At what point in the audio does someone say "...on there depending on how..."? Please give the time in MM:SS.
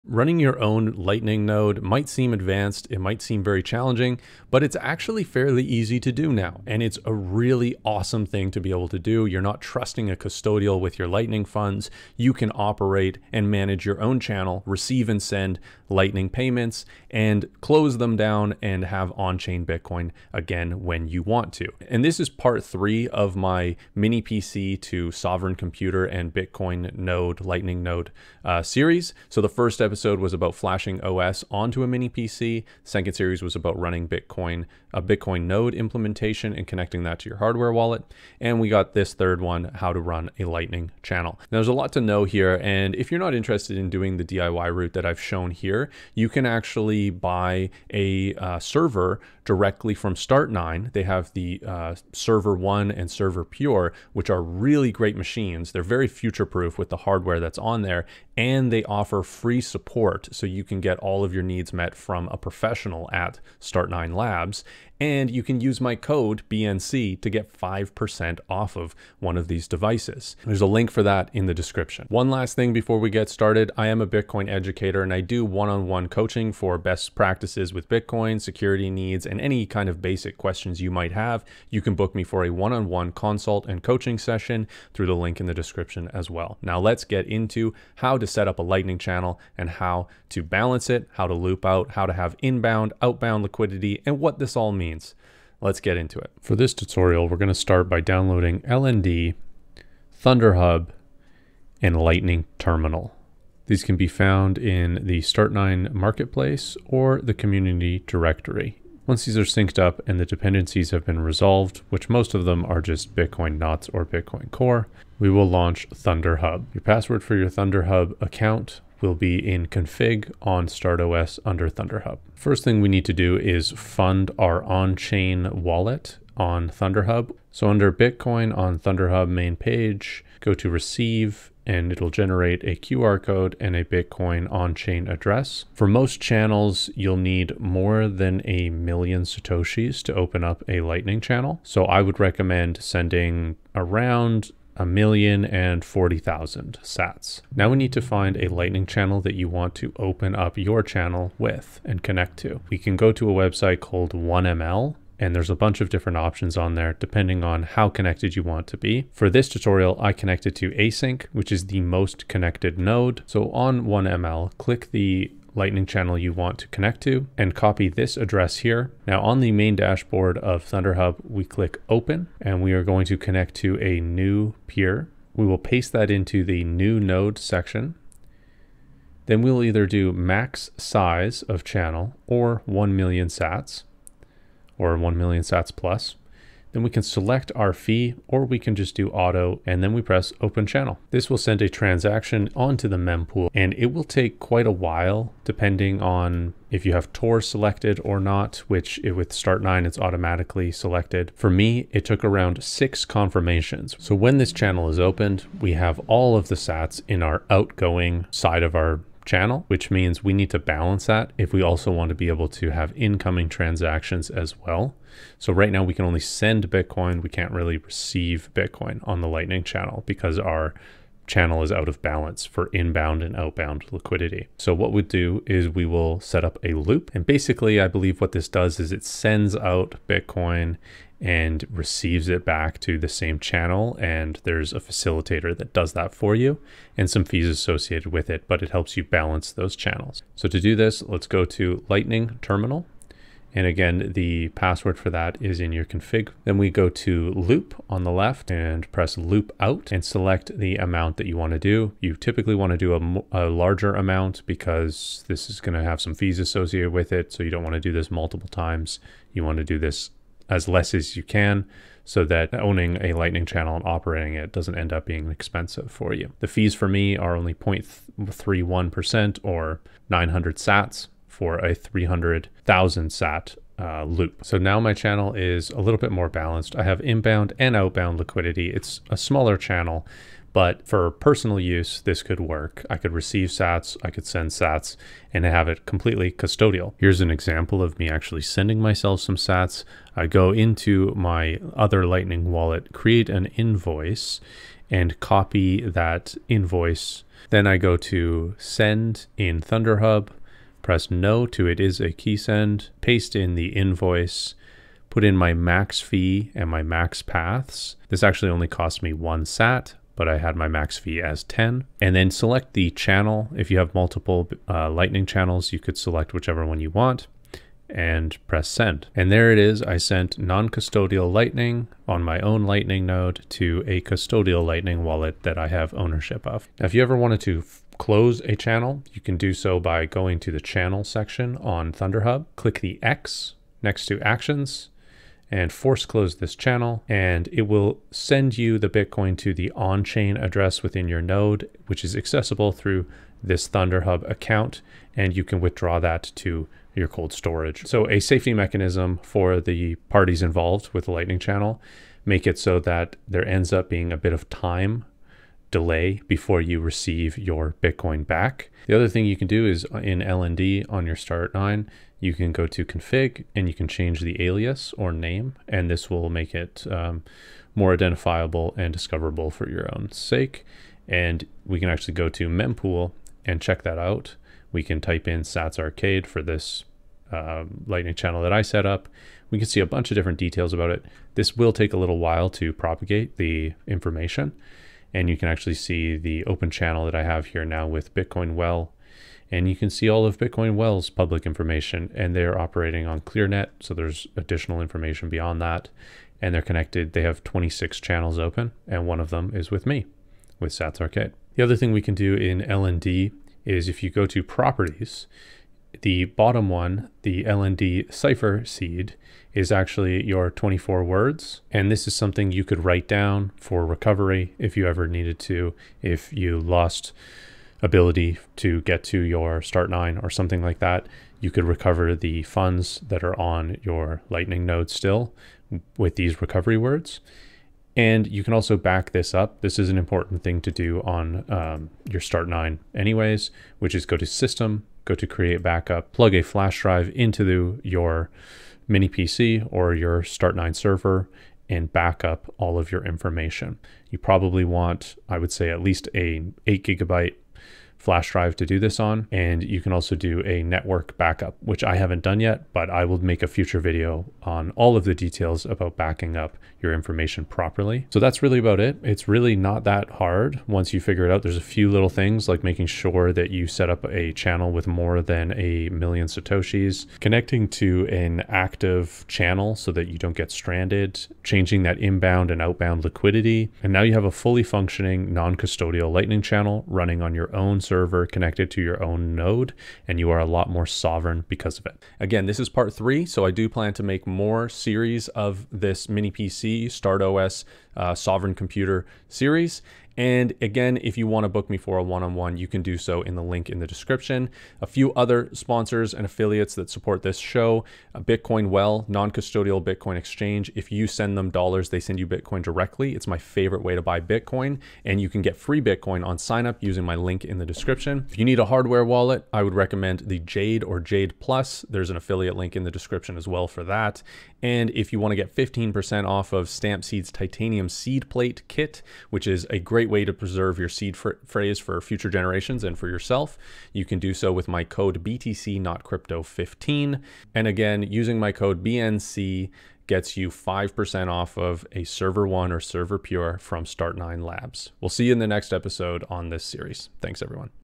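02:36.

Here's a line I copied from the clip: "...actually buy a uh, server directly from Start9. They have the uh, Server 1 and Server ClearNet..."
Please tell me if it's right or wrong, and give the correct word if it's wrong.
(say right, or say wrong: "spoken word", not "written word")
wrong: "Pure", not "ClearNet".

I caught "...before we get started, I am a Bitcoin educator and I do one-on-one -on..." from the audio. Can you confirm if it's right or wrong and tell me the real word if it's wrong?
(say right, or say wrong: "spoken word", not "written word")
right.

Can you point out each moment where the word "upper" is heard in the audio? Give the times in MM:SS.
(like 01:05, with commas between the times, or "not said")
not said.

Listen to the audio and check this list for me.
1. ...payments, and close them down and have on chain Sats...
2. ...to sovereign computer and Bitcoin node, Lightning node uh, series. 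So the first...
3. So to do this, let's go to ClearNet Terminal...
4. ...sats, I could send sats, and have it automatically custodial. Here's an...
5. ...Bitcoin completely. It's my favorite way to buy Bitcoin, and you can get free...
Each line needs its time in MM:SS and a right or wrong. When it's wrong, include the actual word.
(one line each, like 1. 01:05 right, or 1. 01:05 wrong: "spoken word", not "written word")
1. 00:16 wrong: "Bitcoin", not "Sats"
2. 00:24 right
3. 04:00 wrong: "Lightning", not "ClearNet"
4. 04:43 wrong: "completely", not "automatically"
5. 08:22 wrong: "directly", not "completely".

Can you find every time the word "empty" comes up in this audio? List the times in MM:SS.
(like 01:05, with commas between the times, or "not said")
not said.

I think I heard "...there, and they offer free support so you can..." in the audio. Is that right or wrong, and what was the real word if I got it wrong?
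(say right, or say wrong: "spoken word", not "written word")
right.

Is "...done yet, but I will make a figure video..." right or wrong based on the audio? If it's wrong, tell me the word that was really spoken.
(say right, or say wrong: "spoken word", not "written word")
wrong: "future", not "figure".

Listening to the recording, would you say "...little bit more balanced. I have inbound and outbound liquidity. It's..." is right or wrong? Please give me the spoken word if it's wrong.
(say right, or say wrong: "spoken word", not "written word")
right.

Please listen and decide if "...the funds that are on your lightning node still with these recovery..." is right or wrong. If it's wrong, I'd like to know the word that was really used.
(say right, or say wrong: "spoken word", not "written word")
right.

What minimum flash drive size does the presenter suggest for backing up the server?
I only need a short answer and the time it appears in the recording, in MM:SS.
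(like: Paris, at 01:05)
8 gigabytes, at 07:26.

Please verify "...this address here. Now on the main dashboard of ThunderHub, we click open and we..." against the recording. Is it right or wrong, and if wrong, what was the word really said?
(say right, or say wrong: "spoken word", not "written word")
right.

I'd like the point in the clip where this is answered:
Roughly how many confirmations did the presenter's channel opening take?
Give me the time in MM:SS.
03:22.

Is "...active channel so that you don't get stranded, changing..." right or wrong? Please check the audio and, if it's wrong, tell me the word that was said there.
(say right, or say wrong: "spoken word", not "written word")
right.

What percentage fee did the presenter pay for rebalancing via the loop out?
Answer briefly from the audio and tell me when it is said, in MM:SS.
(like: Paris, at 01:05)
0.31%, at 04:27.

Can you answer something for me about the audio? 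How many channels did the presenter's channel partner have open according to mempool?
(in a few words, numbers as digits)
26.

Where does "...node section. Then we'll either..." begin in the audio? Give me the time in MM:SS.
02:56.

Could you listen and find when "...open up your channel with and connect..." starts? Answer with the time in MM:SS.
02:29.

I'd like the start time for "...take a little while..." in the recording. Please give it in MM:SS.
06:21.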